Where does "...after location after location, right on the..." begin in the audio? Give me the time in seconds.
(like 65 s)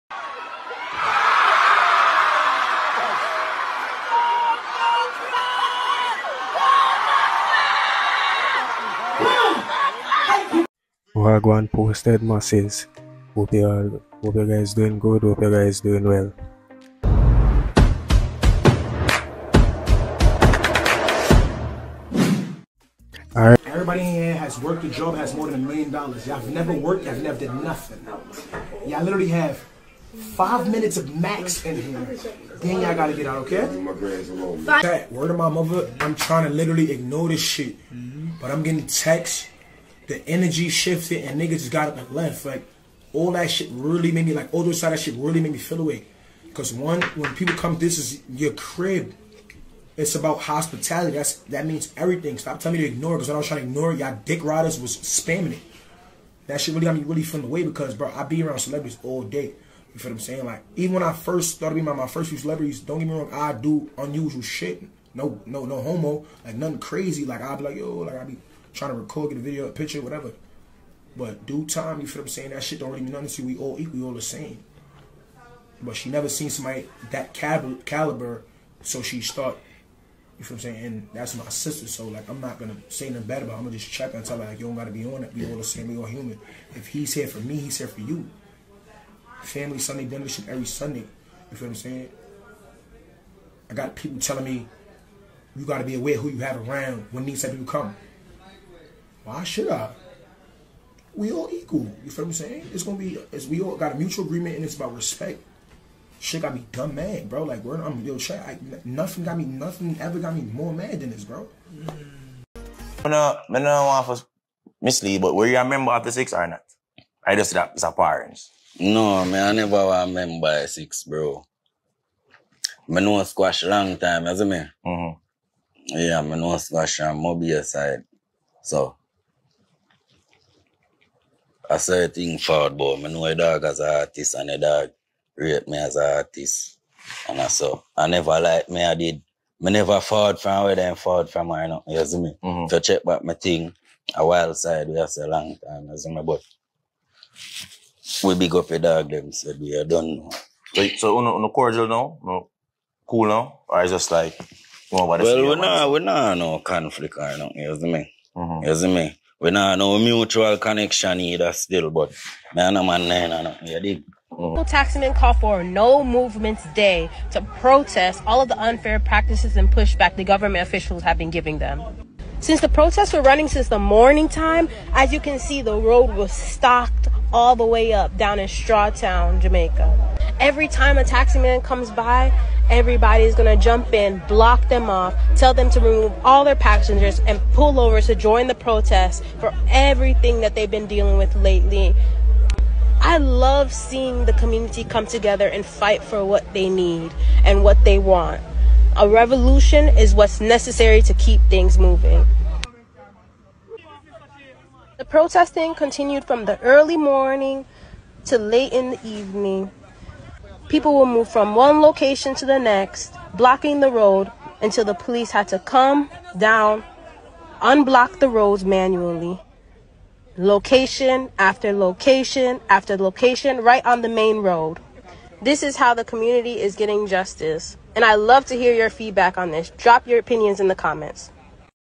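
221 s.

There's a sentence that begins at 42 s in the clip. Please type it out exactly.
Like all that shit really made me like all those side that shit really made me feel away.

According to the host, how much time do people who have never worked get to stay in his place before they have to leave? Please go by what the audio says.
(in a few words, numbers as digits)
5 minutes.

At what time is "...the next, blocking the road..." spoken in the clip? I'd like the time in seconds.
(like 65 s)
212 s.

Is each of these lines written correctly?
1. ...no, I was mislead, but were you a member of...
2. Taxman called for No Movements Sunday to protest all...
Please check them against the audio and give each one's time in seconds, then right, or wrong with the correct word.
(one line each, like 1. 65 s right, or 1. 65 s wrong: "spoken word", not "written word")
1. 113 s right
2. 164 s wrong: "Day", not "Sunday".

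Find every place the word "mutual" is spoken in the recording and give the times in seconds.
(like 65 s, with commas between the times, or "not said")
103 s, 159 s.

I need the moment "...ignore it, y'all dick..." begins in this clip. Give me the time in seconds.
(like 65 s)
53 s.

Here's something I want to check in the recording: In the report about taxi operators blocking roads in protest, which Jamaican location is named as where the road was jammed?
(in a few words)
Strawtown.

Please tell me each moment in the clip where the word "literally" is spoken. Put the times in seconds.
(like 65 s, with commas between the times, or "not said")
29 s, 36 s.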